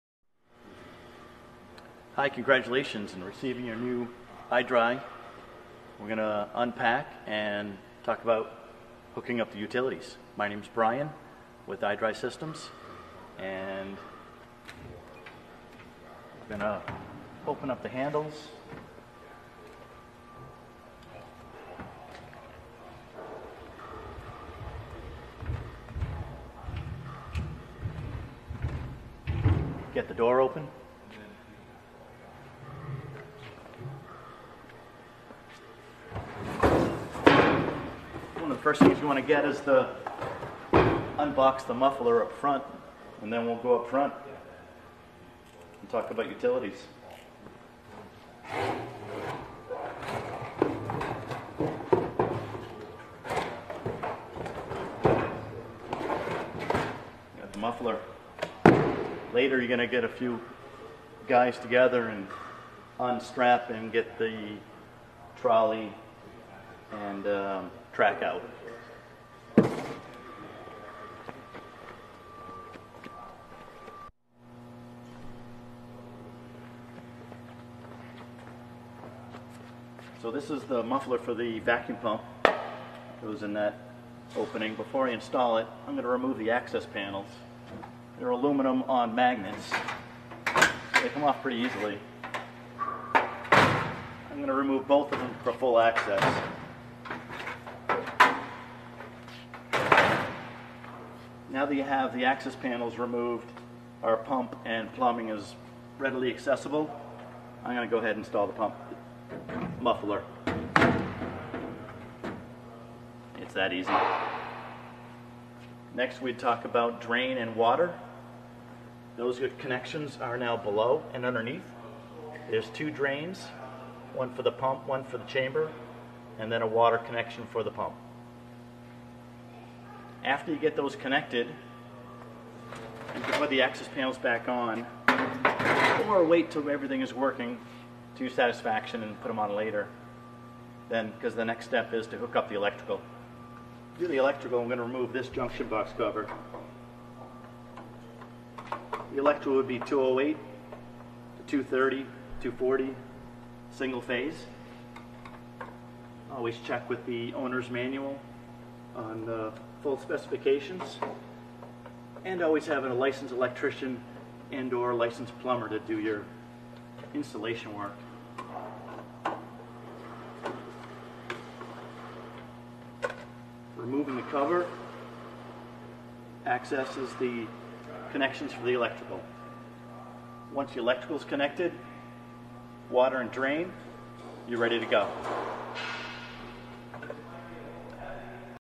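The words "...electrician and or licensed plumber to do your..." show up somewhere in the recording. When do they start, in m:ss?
2:43.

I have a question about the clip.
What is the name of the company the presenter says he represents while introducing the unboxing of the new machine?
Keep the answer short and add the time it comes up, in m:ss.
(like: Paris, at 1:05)
iDRY Systems, at 0:11.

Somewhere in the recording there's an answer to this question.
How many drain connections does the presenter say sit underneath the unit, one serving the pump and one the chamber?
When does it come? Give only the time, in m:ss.
2:02.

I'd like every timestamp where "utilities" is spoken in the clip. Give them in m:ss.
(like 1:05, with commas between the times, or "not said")
0:09, 0:46.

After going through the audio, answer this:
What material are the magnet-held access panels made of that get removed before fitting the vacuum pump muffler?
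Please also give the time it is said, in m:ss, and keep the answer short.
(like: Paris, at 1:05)
Aluminum, at 1:28.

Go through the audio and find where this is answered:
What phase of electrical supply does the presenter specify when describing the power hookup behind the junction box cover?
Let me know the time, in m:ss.
2:33.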